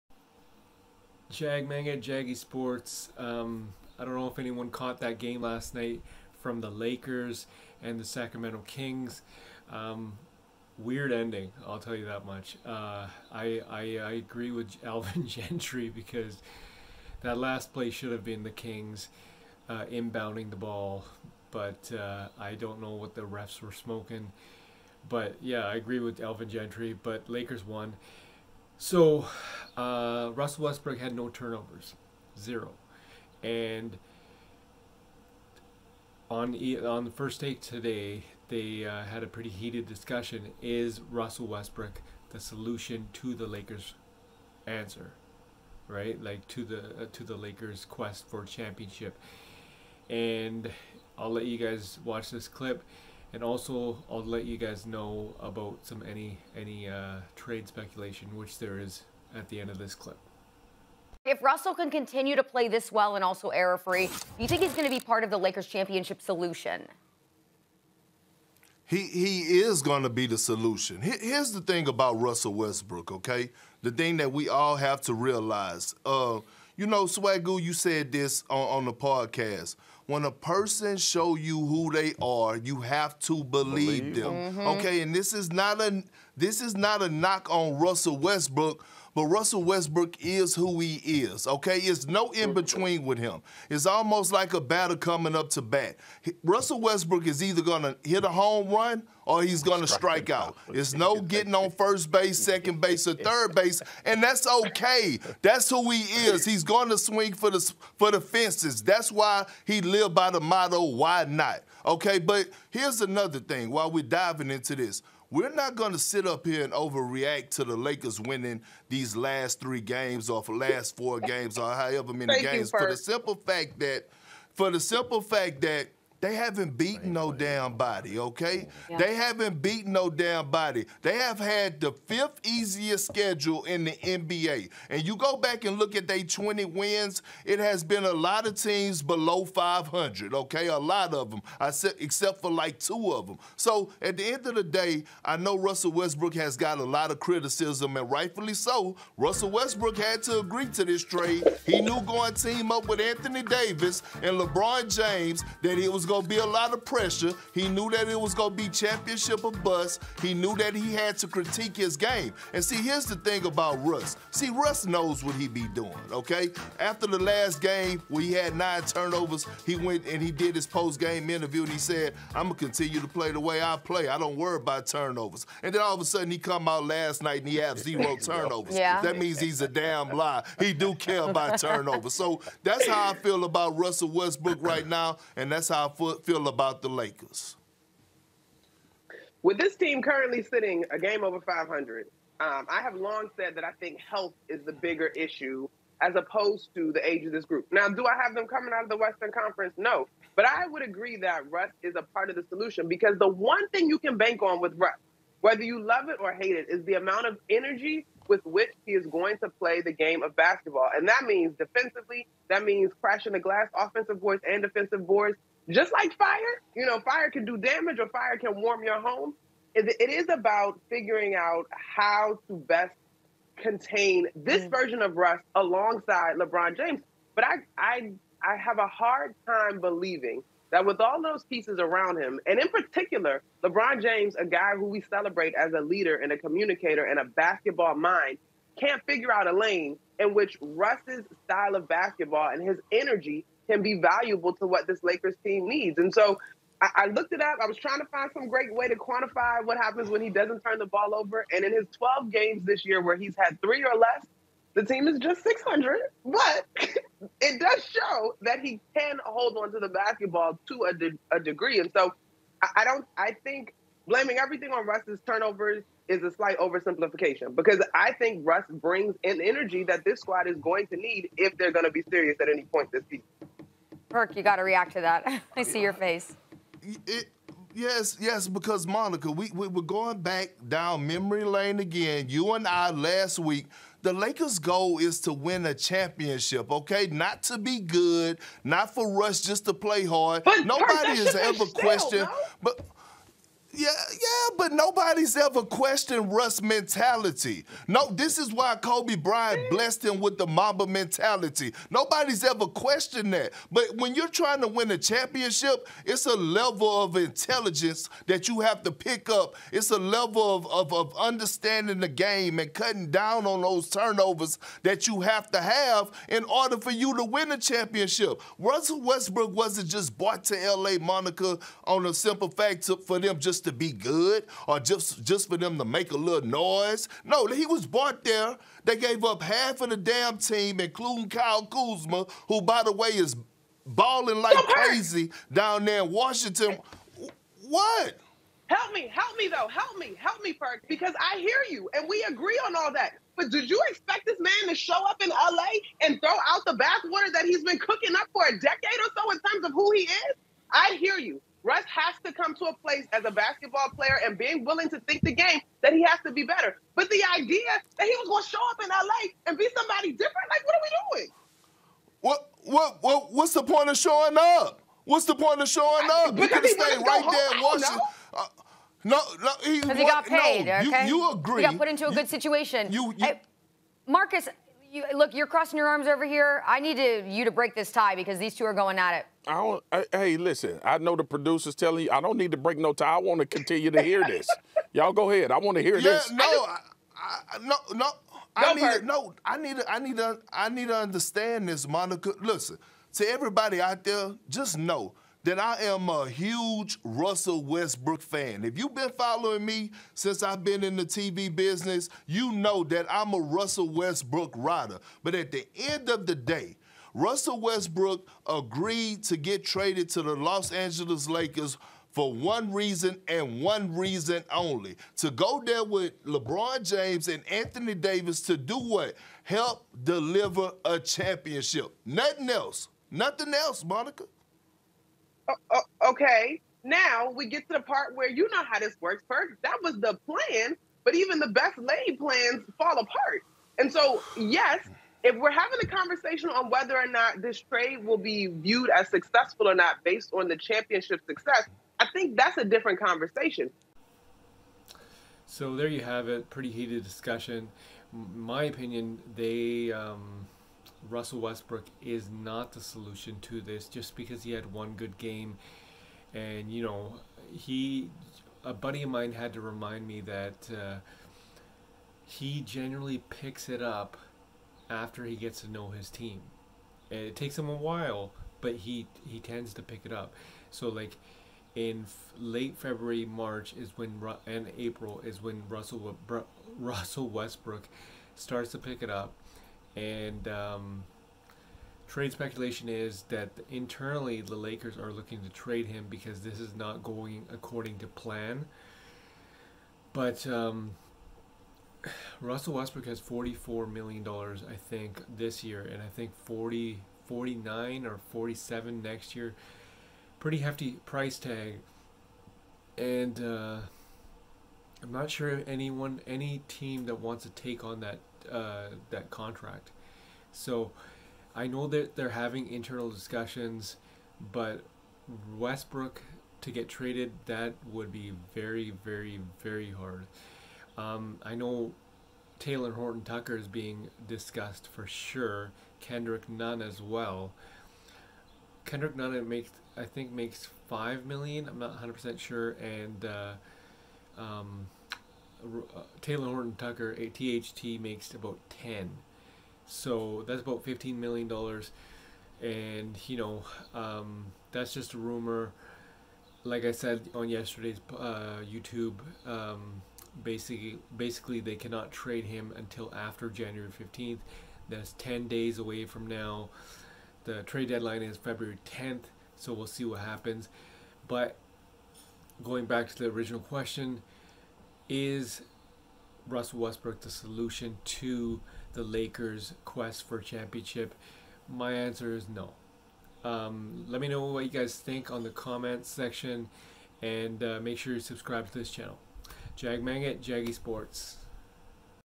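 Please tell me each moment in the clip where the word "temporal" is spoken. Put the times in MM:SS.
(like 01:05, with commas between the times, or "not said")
not said.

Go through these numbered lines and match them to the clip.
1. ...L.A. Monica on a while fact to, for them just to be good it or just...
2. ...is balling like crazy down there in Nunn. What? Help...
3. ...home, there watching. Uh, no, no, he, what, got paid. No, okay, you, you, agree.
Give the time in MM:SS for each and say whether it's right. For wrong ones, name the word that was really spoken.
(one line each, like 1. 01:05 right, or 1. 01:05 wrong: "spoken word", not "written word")
1. 05:20 wrong: "simple", not "while"
2. 05:33 wrong: "Washington", not "Nunn"
3. 06:07 right.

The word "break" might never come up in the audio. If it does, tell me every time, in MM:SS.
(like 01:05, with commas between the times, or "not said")
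06:17, 06:22.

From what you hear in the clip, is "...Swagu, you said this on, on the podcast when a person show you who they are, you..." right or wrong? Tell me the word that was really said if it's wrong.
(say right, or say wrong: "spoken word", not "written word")
right.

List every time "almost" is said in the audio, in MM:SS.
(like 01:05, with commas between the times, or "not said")
01:33.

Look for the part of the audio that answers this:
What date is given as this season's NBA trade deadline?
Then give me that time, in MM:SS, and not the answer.
09:18.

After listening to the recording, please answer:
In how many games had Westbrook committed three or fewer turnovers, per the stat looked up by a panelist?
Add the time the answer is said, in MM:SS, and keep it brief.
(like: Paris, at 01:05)
12, at 04:11.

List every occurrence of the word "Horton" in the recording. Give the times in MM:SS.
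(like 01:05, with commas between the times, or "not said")
08:42, 08:56.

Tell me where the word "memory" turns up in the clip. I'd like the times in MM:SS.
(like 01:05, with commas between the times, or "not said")
04:41.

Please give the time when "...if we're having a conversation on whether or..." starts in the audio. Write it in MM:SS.
07:15.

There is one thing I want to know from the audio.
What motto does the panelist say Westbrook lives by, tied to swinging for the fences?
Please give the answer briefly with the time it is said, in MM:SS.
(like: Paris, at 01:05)
Why not?, at 01:50.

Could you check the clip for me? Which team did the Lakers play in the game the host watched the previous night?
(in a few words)
Sacramento Kings.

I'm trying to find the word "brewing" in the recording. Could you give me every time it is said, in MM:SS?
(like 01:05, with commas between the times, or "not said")
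not said.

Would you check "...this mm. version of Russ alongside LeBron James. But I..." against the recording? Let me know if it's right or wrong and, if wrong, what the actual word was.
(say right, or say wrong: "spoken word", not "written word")
right.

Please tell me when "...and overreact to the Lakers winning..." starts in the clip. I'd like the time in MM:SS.
01:56.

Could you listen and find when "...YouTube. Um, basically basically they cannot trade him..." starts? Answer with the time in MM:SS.
09:08.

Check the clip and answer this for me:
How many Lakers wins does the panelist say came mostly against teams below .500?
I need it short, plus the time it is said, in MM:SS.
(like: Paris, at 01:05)
20, at 02:16.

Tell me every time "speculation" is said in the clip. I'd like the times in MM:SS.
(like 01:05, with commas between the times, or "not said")
00:57, 08:02.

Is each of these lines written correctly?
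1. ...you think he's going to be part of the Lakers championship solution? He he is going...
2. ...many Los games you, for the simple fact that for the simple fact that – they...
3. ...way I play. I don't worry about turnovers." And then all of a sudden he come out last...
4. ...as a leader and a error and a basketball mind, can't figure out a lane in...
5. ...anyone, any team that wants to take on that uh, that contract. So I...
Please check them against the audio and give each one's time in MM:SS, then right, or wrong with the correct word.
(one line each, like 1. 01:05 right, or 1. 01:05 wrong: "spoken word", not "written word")
1. 01:04 right
2. 02:02 wrong: "Thank", not "Los"
3. 02:53 right
4. 03:55 wrong: "communicator", not "error"
5. 08:25 right.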